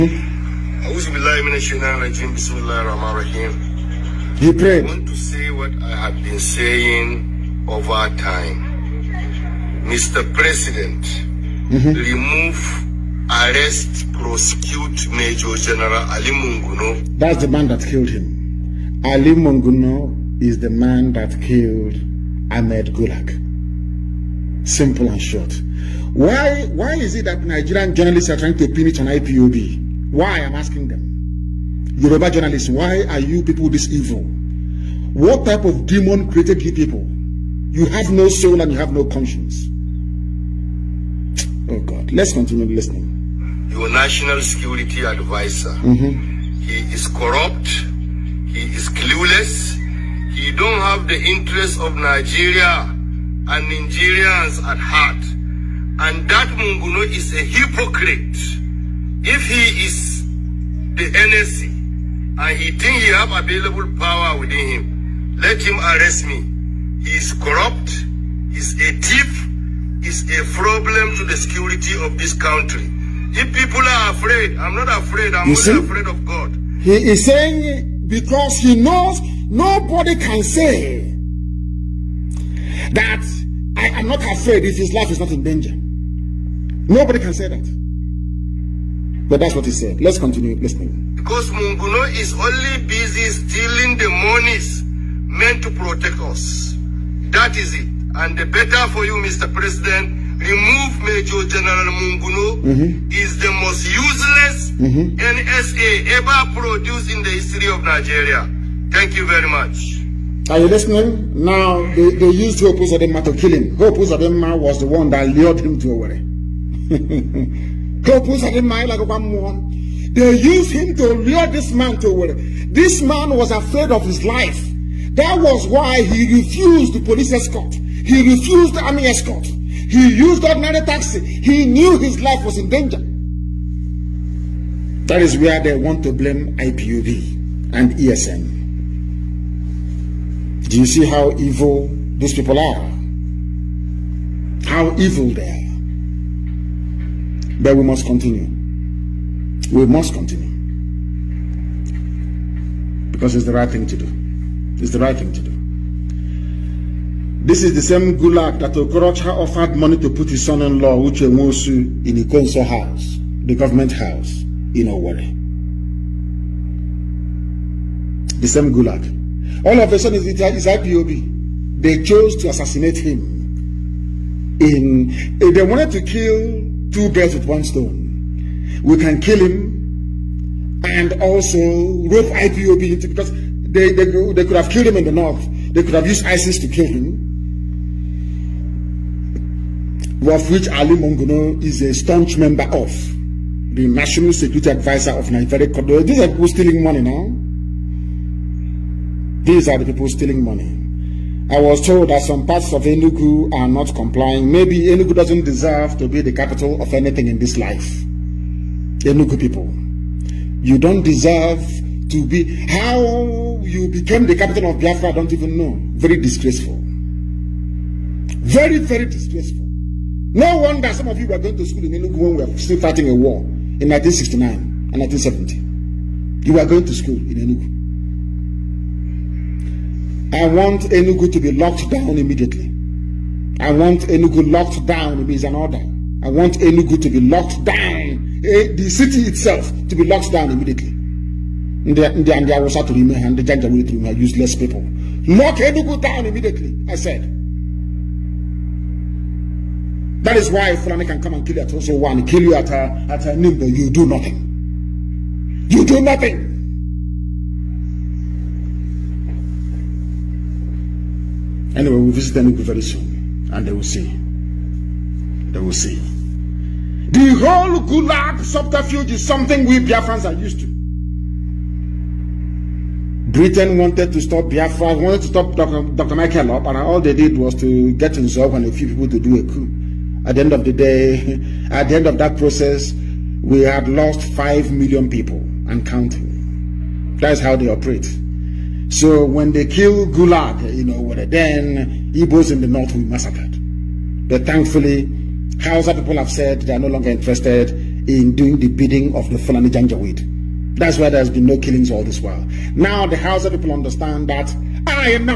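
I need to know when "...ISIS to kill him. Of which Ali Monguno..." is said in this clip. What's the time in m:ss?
3:06.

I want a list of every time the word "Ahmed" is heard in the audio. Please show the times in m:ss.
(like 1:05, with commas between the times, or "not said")
0:22.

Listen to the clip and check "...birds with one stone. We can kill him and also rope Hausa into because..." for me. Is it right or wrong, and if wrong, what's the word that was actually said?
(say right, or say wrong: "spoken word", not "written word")
wrong: "IPOB", not "Hausa".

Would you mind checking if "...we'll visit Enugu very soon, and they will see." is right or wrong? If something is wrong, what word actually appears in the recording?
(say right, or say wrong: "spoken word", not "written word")
right.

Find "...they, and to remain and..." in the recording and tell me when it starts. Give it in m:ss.
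4:01.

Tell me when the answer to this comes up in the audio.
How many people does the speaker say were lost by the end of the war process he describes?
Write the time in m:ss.
4:44.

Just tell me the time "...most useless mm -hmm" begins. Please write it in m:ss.
1:43.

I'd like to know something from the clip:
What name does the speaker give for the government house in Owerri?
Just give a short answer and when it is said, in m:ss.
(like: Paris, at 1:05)
Ikonso house, at 2:42.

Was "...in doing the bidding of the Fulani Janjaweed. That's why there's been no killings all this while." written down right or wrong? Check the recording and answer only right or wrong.
right.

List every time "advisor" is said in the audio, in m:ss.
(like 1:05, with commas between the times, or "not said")
0:45, 3:14.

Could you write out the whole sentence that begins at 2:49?
All of a sudden, it's, it's IPOB.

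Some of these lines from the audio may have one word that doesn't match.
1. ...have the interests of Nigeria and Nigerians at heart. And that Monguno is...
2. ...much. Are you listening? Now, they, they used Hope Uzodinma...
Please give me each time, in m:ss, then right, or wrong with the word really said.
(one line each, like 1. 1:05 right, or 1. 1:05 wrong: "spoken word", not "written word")
1. 0:50 right
2. 1:49 right.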